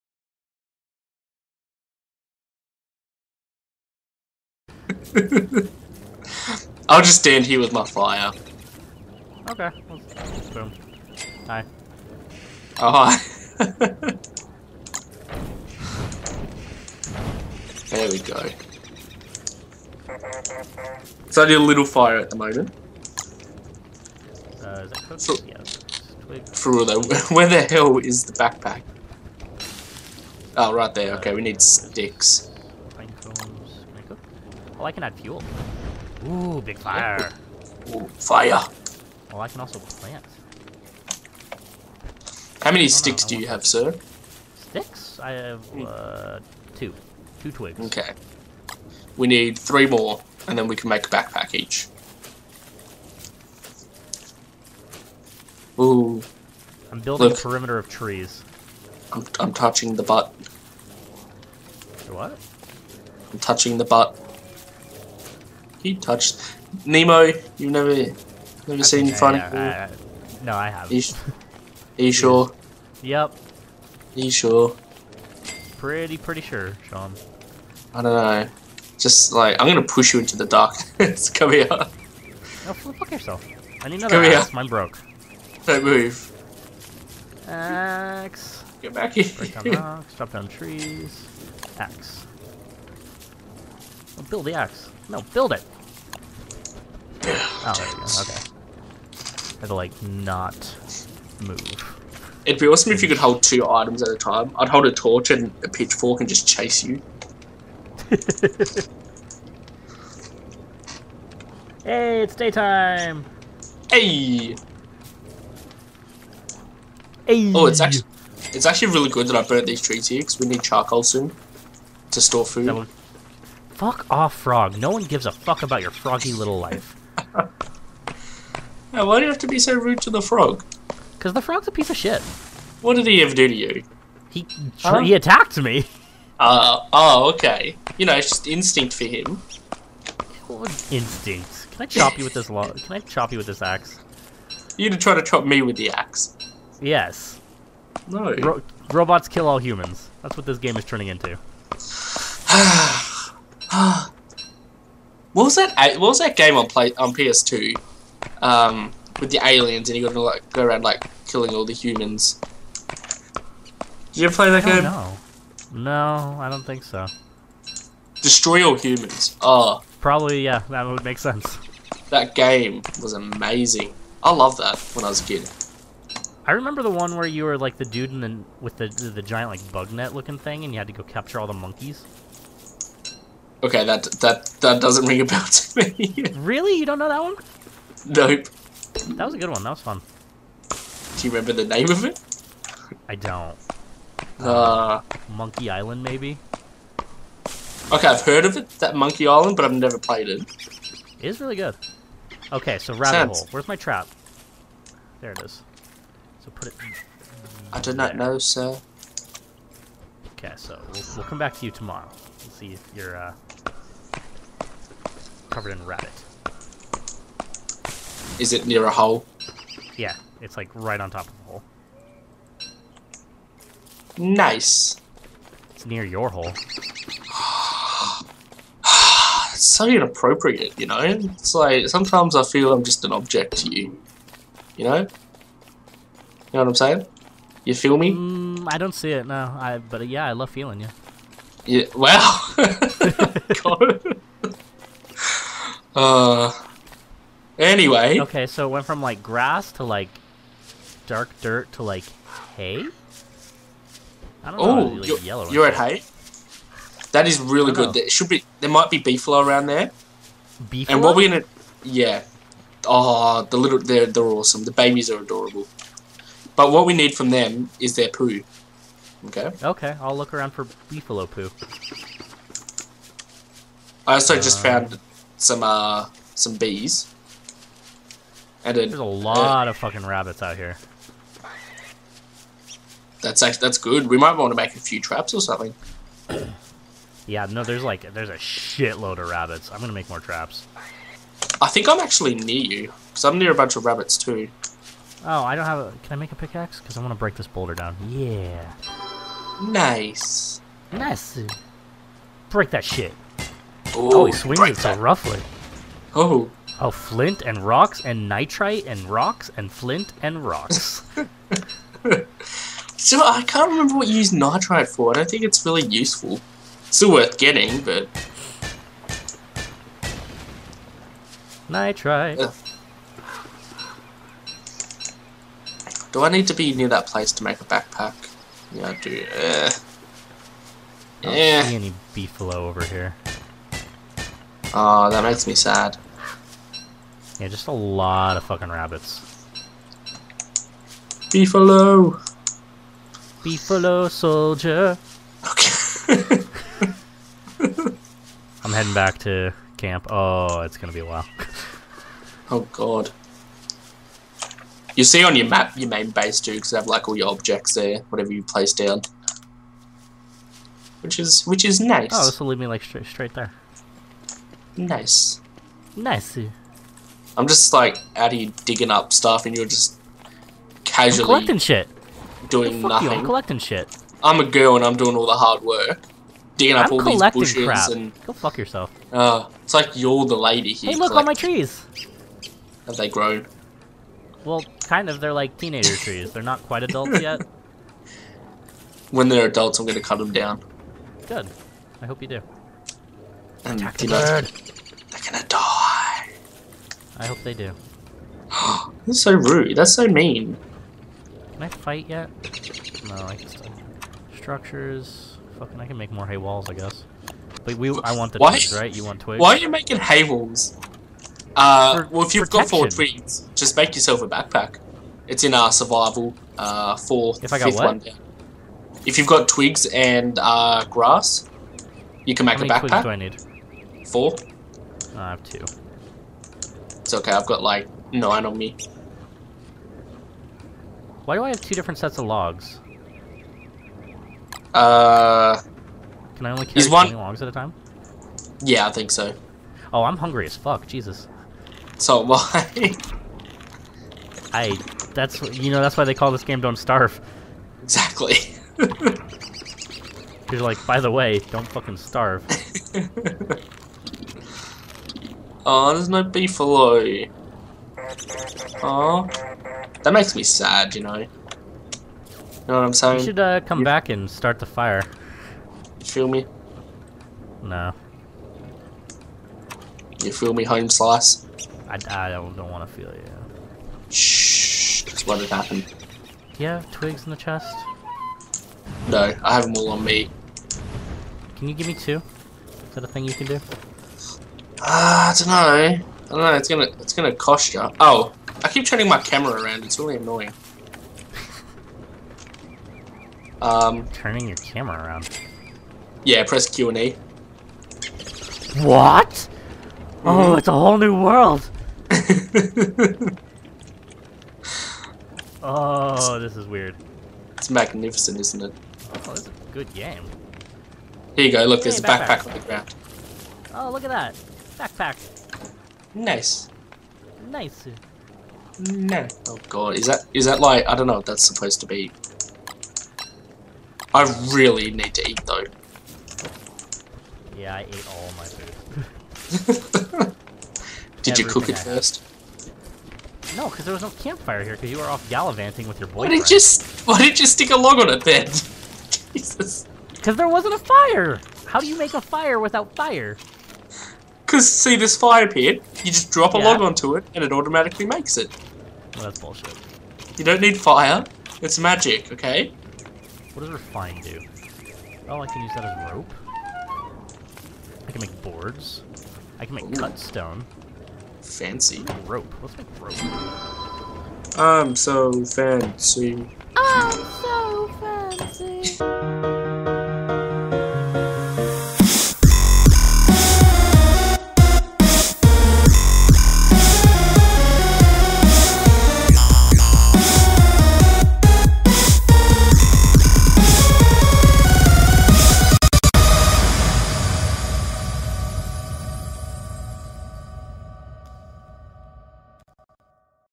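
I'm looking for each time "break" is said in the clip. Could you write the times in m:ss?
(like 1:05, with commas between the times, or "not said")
1:29, 4:57, 5:02.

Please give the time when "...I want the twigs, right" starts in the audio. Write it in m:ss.
6:48.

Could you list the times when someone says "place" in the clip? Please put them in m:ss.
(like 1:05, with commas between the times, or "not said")
5:27, 5:58.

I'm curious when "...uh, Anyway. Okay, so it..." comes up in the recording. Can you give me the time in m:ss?
4:05.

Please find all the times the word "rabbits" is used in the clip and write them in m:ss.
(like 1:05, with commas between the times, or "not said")
3:22, 3:35, 4:40, 4:49, 4:53, 5:38.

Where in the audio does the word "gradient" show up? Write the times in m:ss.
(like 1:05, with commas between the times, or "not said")
not said.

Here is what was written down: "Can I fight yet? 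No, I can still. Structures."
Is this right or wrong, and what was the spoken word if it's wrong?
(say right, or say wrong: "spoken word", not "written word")
right.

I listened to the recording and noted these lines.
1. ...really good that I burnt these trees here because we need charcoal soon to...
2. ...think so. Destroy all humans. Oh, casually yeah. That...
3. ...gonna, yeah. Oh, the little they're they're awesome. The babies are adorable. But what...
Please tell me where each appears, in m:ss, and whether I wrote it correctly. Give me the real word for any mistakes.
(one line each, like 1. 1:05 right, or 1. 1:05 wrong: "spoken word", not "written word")
1. 1:58 right
2. 2:46 wrong: "probably", not "casually"
3. 4:21 right.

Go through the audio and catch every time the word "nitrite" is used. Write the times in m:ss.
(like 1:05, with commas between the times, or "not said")
5:08, 5:14, 5:21.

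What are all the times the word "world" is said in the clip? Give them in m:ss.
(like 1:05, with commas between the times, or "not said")
8:21.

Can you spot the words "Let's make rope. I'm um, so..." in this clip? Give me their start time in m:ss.
9:22.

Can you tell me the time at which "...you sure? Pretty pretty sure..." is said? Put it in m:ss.
1:14.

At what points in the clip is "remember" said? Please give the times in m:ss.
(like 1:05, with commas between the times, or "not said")
2:56, 3:11, 5:13.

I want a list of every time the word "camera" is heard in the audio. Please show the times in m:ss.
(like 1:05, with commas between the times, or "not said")
8:09, 8:14.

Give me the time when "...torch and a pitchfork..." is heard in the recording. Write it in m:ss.
1:44.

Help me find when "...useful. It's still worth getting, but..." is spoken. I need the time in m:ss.
5:15.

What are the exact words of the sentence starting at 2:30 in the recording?
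That's what this game is turning into.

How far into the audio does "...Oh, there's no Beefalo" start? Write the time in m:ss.
7:35.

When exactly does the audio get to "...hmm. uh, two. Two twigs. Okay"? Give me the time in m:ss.
0:45.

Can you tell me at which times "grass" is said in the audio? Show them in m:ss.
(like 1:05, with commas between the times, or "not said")
4:09, 7:00.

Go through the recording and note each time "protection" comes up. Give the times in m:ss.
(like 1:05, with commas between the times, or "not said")
6:52.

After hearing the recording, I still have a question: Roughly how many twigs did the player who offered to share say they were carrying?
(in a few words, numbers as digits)
9.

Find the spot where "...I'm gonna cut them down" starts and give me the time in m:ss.
6:29.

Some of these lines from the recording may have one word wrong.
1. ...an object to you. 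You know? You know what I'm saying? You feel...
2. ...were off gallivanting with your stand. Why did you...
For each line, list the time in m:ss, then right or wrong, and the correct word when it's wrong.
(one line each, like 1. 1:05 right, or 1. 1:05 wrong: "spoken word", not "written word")
1. 3:53 right
2. 8:54 wrong: "boyfriend", not "stand".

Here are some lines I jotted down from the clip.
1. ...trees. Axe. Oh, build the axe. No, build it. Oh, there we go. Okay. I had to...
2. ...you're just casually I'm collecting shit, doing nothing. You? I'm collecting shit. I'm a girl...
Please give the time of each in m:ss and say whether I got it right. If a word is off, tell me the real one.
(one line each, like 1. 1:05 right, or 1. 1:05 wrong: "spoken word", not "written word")
1. 1:30 right
2. 6:09 right.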